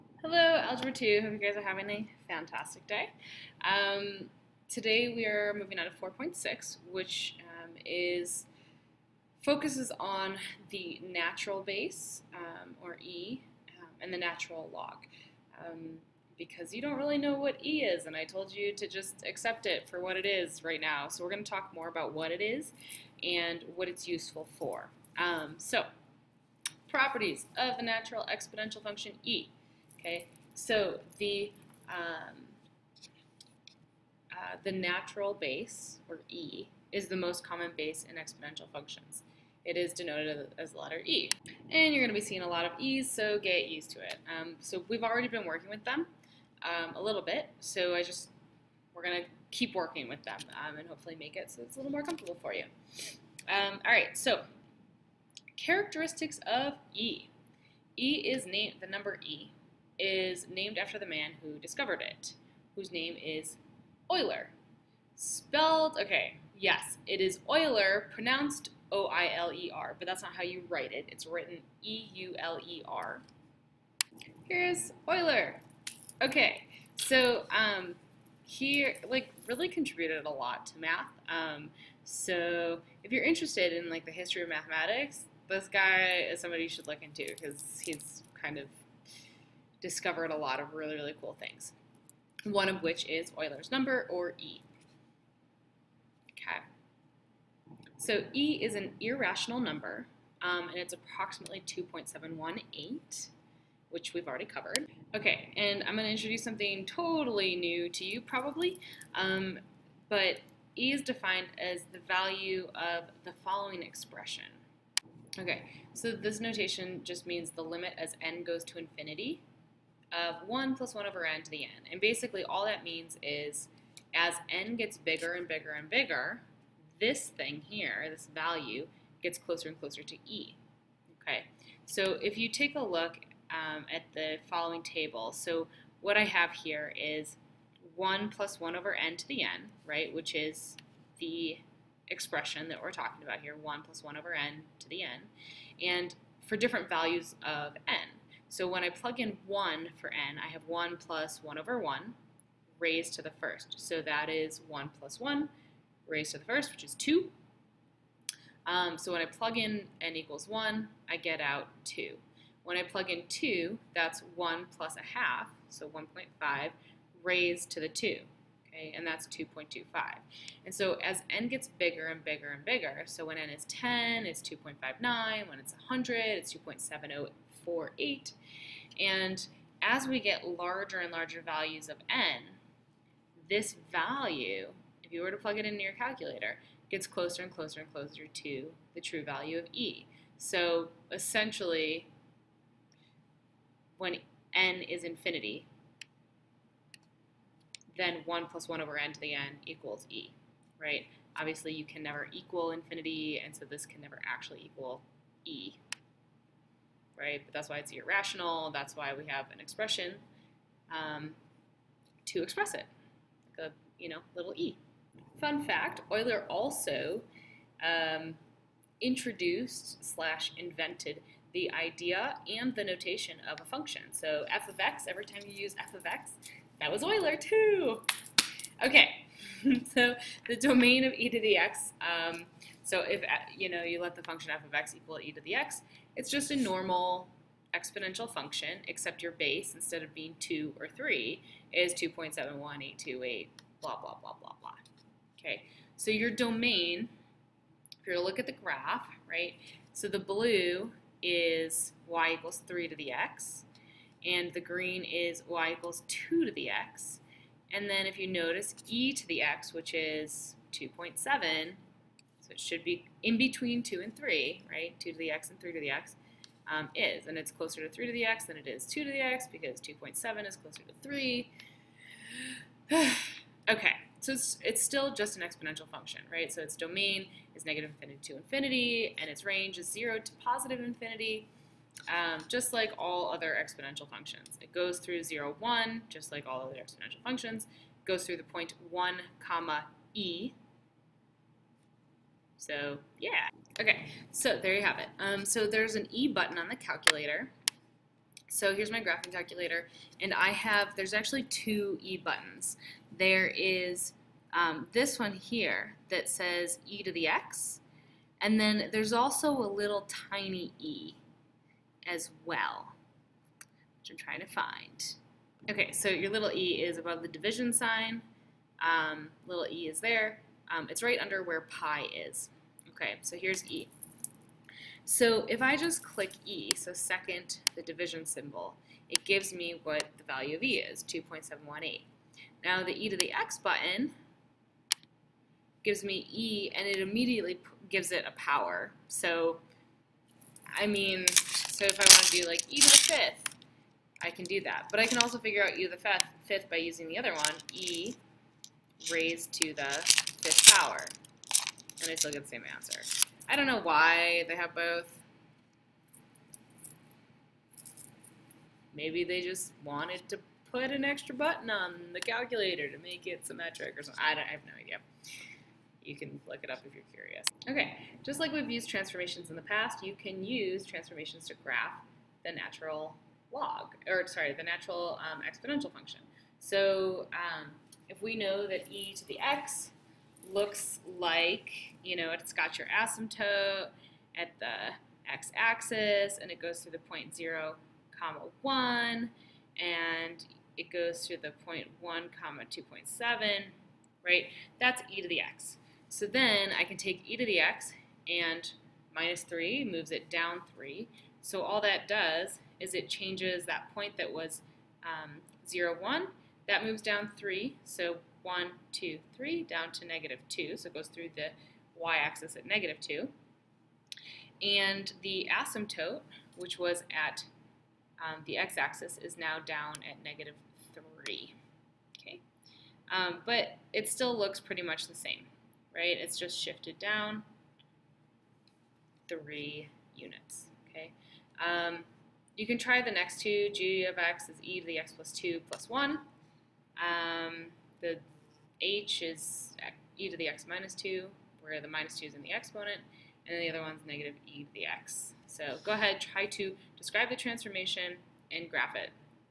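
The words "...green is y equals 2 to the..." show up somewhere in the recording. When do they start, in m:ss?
4:14.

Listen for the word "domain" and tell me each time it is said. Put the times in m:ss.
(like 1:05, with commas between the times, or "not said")
3:50, 4:06, 4:36.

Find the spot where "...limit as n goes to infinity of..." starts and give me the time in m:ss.
1:57.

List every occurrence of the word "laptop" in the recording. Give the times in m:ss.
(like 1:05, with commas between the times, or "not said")
not said.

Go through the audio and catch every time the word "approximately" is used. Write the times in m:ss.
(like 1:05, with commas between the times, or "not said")
1:40.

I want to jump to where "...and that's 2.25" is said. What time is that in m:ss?
2:48.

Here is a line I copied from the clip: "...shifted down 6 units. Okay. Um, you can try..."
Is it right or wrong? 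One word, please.
wrong.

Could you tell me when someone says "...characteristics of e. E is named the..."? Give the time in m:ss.
0:55.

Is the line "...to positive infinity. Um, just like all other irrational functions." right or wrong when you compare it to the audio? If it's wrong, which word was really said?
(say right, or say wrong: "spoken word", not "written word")
wrong: "exponential", not "irrational".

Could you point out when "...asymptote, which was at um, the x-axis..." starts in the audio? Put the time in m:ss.
6:55.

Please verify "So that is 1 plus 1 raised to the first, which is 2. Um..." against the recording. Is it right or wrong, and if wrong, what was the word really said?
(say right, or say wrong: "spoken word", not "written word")
right.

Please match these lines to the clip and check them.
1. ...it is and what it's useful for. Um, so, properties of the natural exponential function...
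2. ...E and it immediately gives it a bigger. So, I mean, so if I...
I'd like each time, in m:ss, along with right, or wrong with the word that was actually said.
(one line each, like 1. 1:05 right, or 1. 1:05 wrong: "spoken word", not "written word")
1. 0:22 right
2. 5:36 wrong: "power", not "bigger".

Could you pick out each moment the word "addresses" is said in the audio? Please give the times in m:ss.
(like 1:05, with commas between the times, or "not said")
not said.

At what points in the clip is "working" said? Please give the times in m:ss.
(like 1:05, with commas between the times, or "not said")
0:45, 0:49.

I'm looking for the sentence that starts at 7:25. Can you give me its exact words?
So go ahead, try to describe the transformation and graph it.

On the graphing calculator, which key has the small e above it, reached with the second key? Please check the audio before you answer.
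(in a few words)
division sign.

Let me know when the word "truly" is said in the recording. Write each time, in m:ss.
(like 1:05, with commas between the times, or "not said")
not said.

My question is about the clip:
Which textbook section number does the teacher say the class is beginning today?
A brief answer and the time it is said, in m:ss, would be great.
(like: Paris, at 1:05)
4.6, at 0:05.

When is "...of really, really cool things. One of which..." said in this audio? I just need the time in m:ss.
1:30.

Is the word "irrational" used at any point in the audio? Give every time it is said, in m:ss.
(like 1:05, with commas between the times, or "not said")
1:39, 3:27.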